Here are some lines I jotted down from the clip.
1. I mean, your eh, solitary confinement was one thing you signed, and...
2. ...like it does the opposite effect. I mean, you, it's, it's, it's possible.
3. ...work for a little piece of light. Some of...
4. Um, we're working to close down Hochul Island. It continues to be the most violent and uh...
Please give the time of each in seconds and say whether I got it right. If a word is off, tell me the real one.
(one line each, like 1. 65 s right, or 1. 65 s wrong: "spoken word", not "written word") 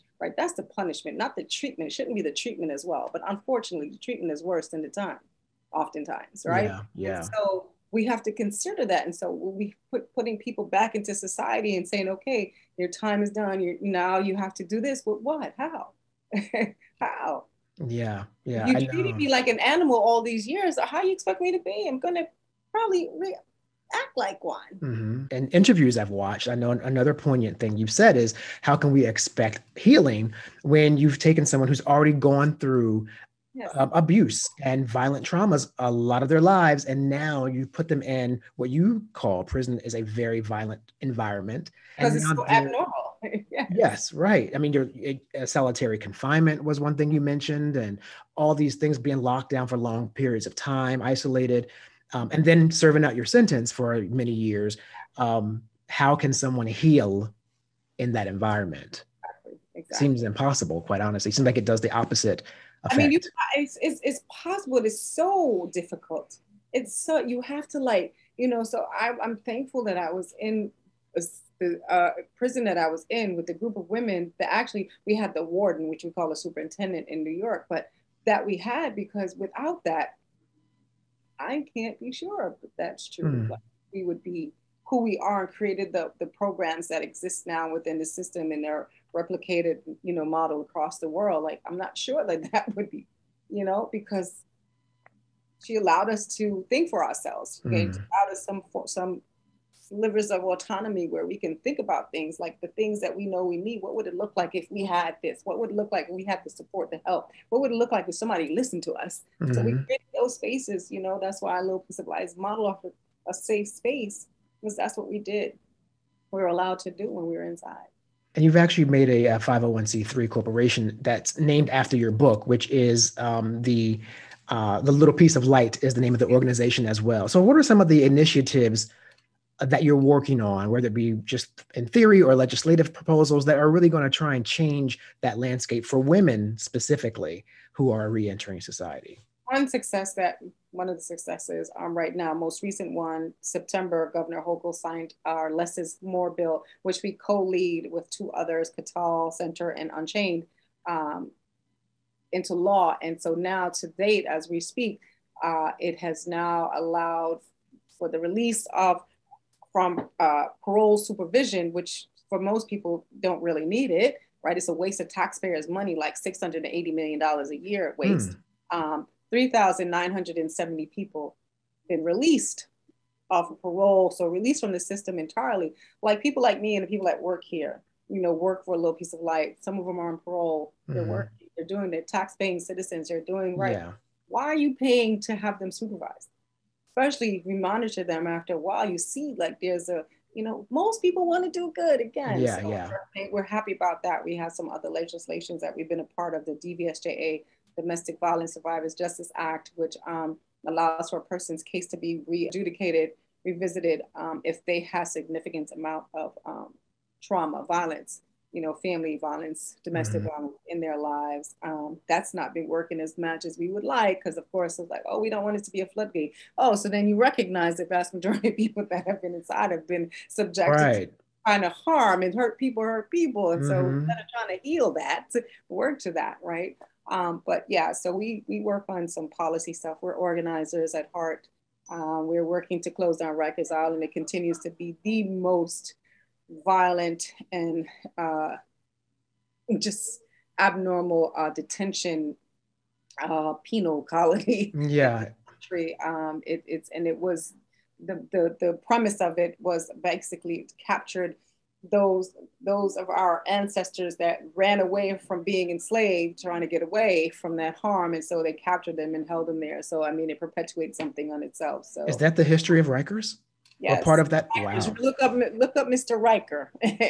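1. 44 s wrong: "mentioned", not "signed"
2. 61 s right
3. 178 s right
4. 231 s wrong: "Rikers", not "Hochul".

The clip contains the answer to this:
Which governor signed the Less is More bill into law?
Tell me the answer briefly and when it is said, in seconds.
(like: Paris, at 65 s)
Governor Hochul, at 144 s.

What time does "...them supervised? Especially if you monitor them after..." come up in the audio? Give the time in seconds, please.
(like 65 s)
185 s.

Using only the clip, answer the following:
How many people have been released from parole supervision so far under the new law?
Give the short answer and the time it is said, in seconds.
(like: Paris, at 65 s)
3,970, at 169 s.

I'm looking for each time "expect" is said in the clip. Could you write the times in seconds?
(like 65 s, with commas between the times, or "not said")
21 s, 29 s.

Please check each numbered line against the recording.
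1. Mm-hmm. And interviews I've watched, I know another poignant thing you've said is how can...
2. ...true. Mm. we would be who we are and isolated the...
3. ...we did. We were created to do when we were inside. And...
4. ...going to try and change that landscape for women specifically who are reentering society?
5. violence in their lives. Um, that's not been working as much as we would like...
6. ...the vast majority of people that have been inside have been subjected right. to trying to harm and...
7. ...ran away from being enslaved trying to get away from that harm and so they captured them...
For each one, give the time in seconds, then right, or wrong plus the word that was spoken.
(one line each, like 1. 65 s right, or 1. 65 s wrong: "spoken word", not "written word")
1. 24 s right
2. 83 s wrong: "created", not "isolated"
3. 115 s wrong: "allowed", not "created"
4. 133 s right
5. 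210 s right
6. 217 s right
7. 254 s right.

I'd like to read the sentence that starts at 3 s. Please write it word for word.
But unfortunately, the treatment is worse than the time, oftentimes, right?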